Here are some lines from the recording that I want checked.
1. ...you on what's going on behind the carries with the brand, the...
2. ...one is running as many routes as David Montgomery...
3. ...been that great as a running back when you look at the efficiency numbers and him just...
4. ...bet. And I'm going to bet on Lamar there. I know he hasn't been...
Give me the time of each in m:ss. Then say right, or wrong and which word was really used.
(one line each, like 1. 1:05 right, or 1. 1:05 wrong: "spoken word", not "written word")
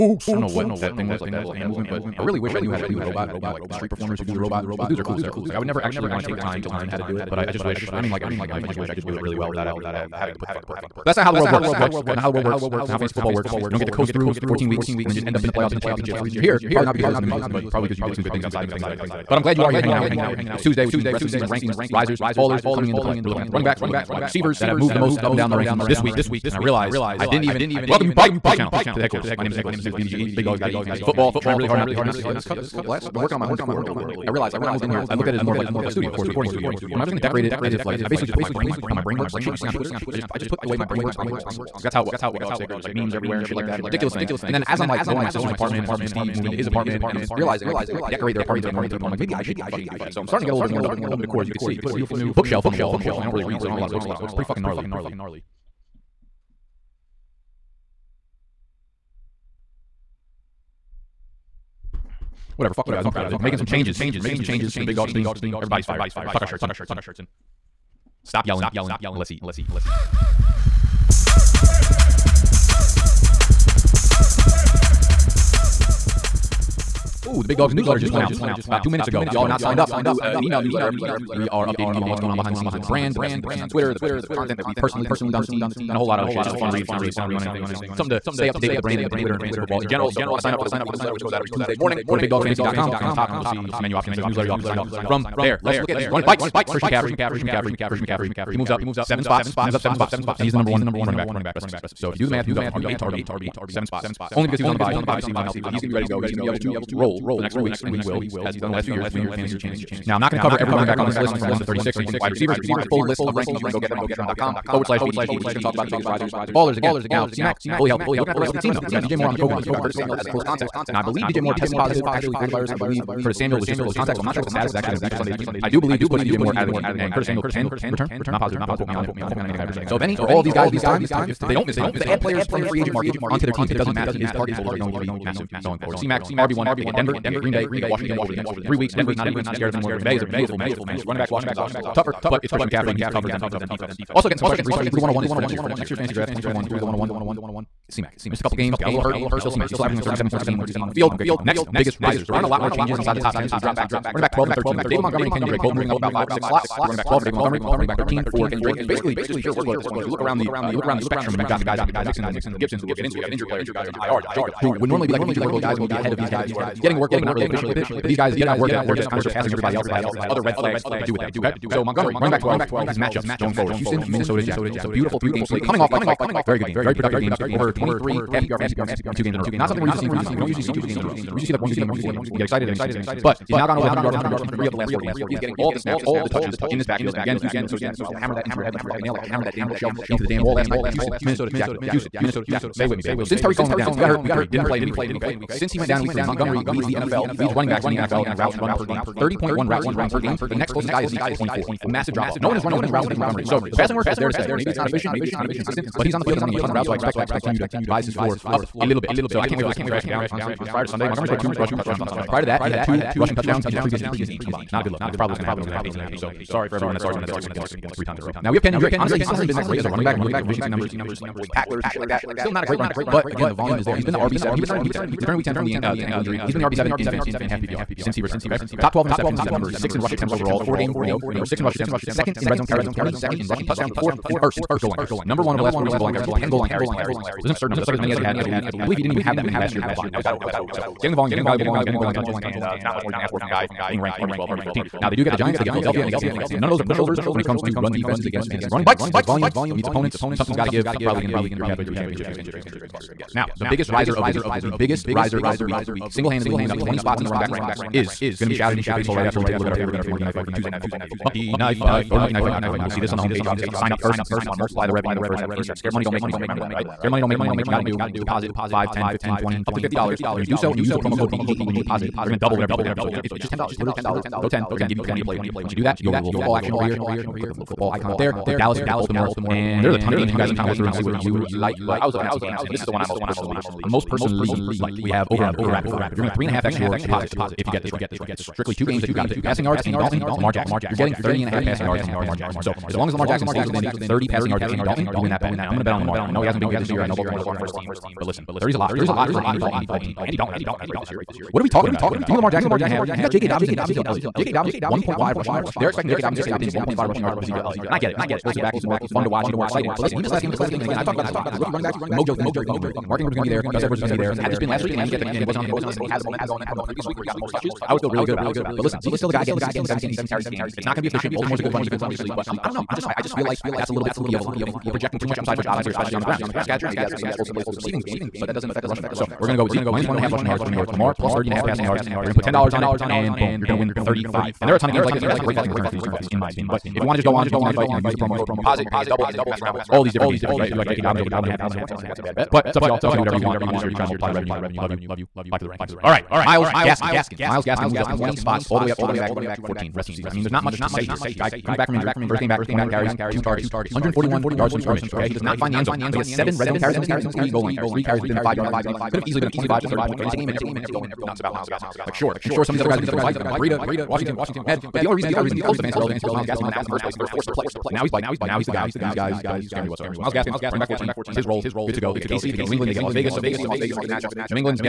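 1. 1:21 wrong: "scenes", not "carries"
2. 3:22 right
3. 3:39 right
4. 4:55 right.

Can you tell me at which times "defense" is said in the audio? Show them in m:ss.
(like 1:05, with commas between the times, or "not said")
2:19, 2:23, 4:07, 5:21.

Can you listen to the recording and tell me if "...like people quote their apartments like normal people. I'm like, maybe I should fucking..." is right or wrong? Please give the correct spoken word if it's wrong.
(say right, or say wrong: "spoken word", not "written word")
wrong: "decorate", not "quote".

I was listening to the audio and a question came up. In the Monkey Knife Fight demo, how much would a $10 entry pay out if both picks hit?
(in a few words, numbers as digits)
$35.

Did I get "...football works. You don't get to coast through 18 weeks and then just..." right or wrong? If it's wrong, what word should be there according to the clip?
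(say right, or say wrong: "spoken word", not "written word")
wrong: "14", not "18".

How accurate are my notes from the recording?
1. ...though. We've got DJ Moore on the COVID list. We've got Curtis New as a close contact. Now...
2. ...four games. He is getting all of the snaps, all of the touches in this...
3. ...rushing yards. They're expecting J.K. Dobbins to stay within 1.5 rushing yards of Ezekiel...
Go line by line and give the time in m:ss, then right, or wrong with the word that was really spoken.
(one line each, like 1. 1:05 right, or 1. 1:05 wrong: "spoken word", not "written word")
1. 1:58 wrong: "Samuel", not "New"
2. 3:04 right
3. 5:05 right.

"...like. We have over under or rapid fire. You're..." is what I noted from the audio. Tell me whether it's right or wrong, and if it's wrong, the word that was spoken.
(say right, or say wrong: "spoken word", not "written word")
right.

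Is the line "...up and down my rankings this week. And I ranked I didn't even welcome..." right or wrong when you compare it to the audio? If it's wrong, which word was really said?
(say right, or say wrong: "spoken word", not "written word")
wrong: "realized", not "ranked".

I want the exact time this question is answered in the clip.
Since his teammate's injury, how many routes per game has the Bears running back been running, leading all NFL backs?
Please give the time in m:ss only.
3:19.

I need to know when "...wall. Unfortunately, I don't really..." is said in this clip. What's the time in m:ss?
0:52.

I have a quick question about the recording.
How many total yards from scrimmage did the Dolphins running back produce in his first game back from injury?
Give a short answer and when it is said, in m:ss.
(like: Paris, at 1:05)
141, at 5:53.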